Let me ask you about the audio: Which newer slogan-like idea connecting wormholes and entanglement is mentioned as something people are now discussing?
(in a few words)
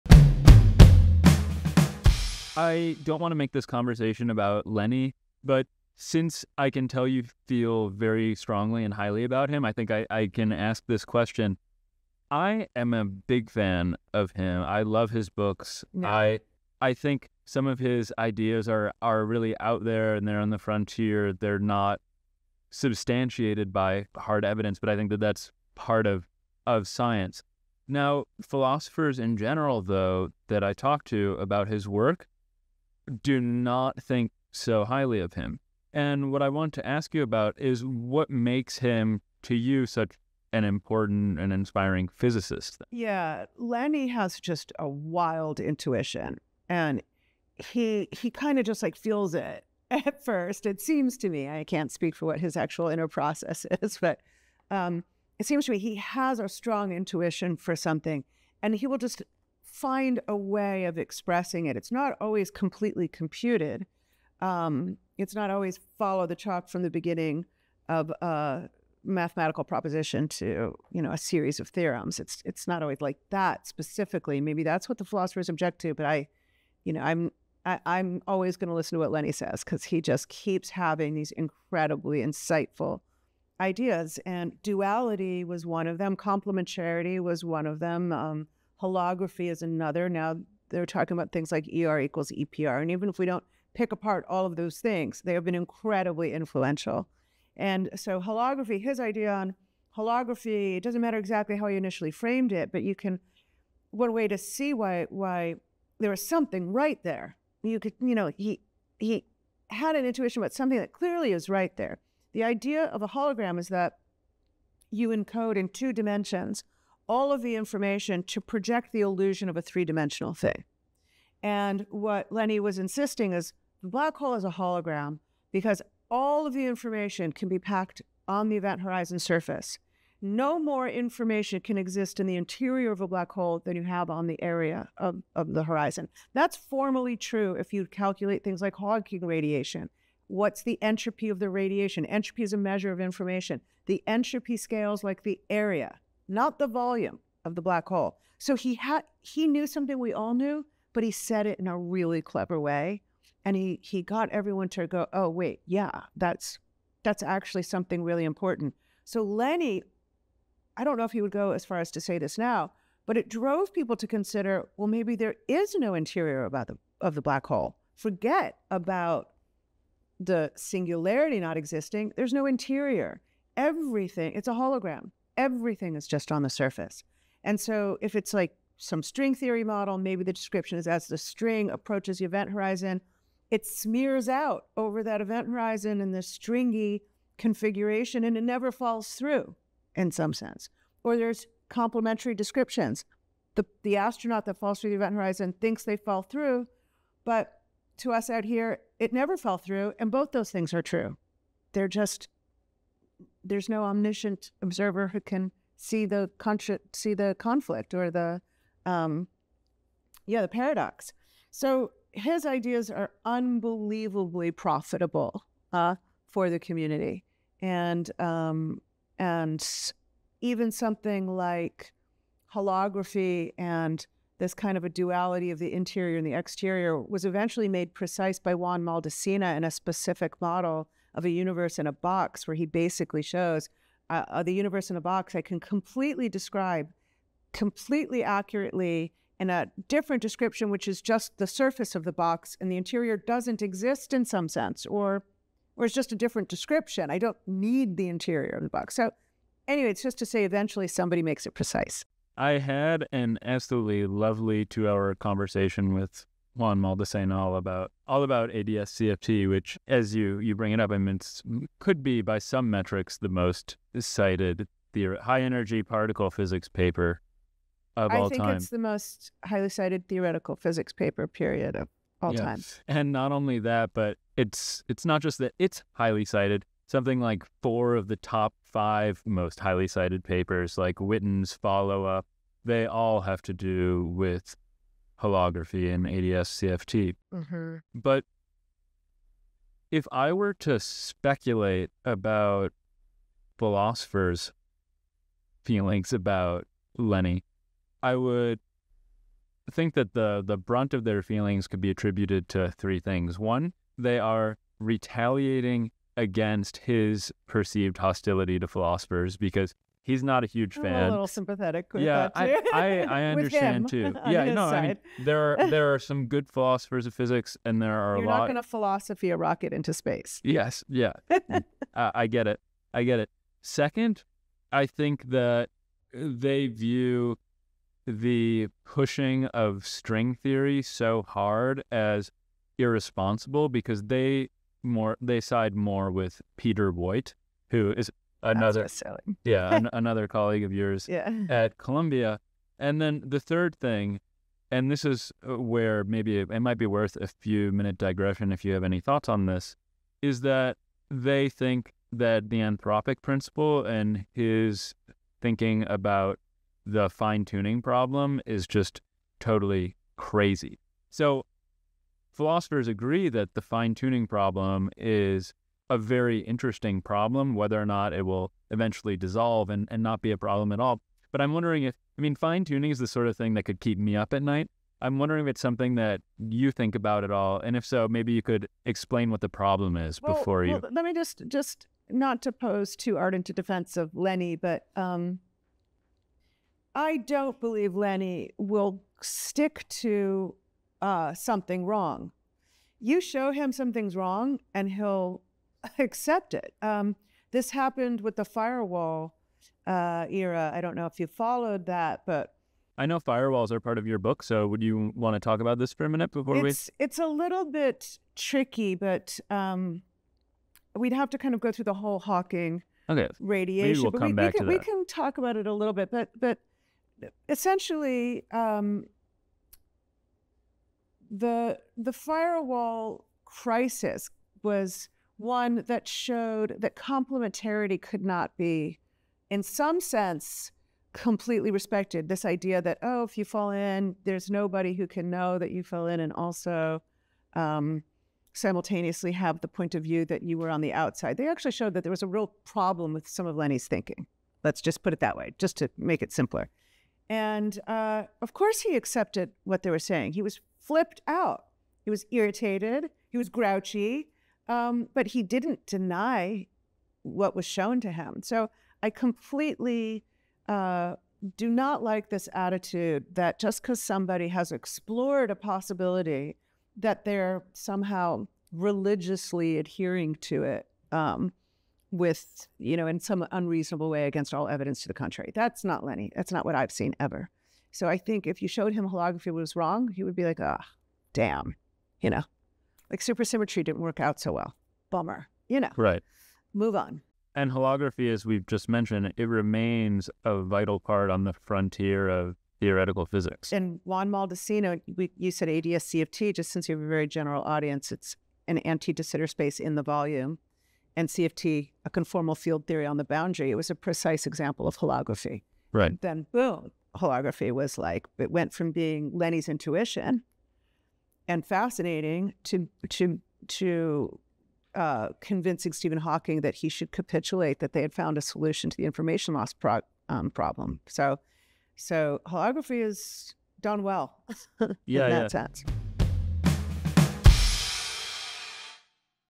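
ER equals EPR.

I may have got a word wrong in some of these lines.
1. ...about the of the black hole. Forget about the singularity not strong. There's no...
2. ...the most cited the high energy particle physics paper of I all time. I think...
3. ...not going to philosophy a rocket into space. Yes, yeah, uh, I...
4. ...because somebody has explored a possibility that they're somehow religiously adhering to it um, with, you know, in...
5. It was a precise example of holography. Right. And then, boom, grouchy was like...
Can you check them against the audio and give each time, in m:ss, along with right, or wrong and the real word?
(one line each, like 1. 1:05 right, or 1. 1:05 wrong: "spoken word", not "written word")
1. 2:46 wrong: "existing", not "strong"
2. 4:23 right
3. 5:18 right
4. 7:43 right
5. 8:23 wrong: "holography", not "grouchy".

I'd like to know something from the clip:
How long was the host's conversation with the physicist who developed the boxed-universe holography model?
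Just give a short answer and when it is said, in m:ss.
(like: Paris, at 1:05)
2 hours, at 4:14.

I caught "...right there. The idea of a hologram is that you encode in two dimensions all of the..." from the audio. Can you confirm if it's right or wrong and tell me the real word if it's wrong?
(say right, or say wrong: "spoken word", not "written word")
right.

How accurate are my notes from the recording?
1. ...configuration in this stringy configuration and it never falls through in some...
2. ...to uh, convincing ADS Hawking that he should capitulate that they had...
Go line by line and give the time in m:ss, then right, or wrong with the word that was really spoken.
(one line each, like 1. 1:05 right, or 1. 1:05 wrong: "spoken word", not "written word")
1. 3:05 wrong: "horizon", not "configuration"
2. 8:33 wrong: "Stephen", not "ADS".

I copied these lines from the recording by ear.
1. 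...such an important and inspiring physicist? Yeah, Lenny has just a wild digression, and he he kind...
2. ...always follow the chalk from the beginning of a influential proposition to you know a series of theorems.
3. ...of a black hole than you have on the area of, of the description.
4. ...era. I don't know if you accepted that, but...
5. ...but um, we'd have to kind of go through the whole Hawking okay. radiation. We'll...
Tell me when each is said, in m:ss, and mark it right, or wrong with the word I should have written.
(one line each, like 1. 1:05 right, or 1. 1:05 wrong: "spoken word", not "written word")
1. 0:39 wrong: "intuition", not "digression"
2. 1:05 wrong: "mathematical", not "influential"
3. 2:12 wrong: "horizon", not "description"
4. 6:40 wrong: "followed", not "accepted"
5. 6:48 right.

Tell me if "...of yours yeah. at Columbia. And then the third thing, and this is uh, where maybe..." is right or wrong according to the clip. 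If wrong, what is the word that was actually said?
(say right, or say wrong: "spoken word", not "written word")
right.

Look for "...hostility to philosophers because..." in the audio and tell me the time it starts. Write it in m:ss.
5:07.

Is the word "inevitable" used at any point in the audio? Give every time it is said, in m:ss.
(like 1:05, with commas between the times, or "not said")
not said.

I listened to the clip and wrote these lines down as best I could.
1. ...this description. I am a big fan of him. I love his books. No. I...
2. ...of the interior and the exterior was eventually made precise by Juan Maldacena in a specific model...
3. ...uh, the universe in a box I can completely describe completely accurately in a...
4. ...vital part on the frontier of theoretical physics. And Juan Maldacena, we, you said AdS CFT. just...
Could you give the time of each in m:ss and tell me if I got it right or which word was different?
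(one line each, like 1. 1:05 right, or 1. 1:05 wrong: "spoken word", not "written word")
1. 0:10 wrong: "question", not "description"
2. 3:45 right
3. 3:54 right
4. 8:10 right.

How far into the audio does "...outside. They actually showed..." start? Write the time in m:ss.
7:20.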